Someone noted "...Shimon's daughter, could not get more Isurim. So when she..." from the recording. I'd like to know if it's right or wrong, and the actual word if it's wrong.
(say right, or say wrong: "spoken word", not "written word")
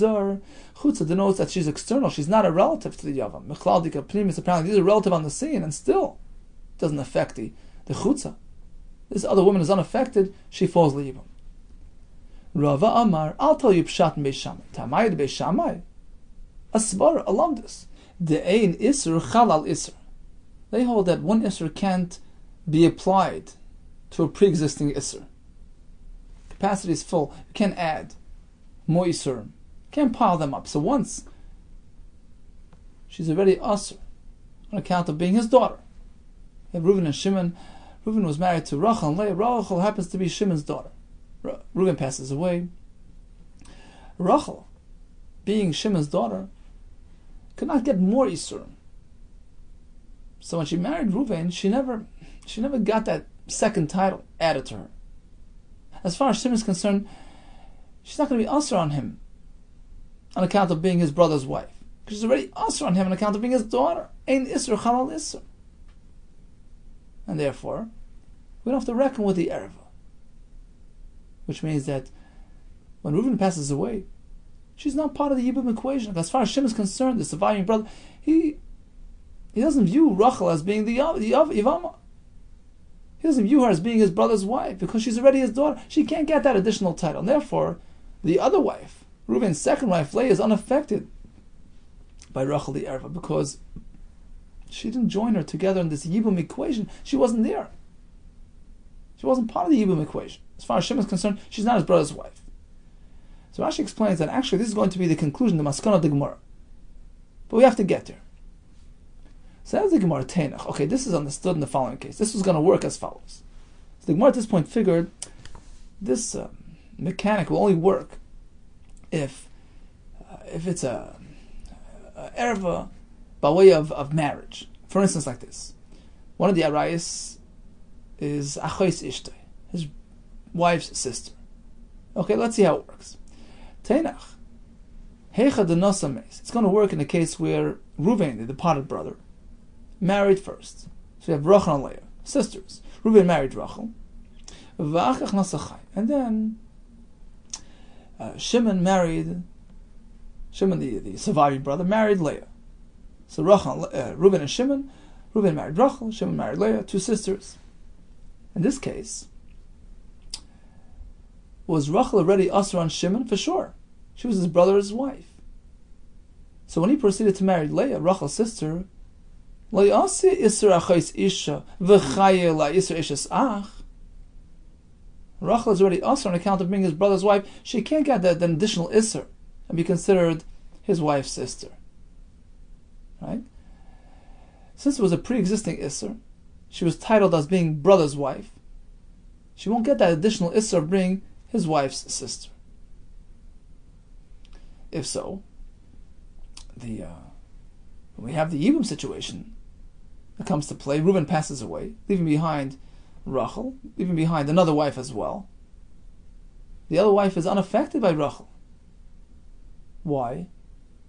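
right.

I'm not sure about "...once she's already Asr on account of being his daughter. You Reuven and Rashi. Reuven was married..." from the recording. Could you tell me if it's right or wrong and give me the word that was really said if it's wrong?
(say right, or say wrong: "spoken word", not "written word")
wrong: "Shimon", not "Rashi".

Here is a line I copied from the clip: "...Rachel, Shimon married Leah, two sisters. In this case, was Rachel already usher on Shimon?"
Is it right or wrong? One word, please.
right.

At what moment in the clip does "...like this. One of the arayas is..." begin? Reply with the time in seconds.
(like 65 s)
125 s.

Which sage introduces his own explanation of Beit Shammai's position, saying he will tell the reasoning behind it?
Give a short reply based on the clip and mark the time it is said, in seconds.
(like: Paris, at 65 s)
Rava, at 12 s.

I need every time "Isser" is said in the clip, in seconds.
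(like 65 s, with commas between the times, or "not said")
178 s, 185 s, 190 s.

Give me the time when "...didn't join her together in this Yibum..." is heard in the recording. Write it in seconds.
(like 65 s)
94 s.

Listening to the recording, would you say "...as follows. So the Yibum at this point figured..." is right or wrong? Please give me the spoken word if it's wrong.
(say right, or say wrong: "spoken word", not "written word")
wrong: "Gemara", not "Yibum".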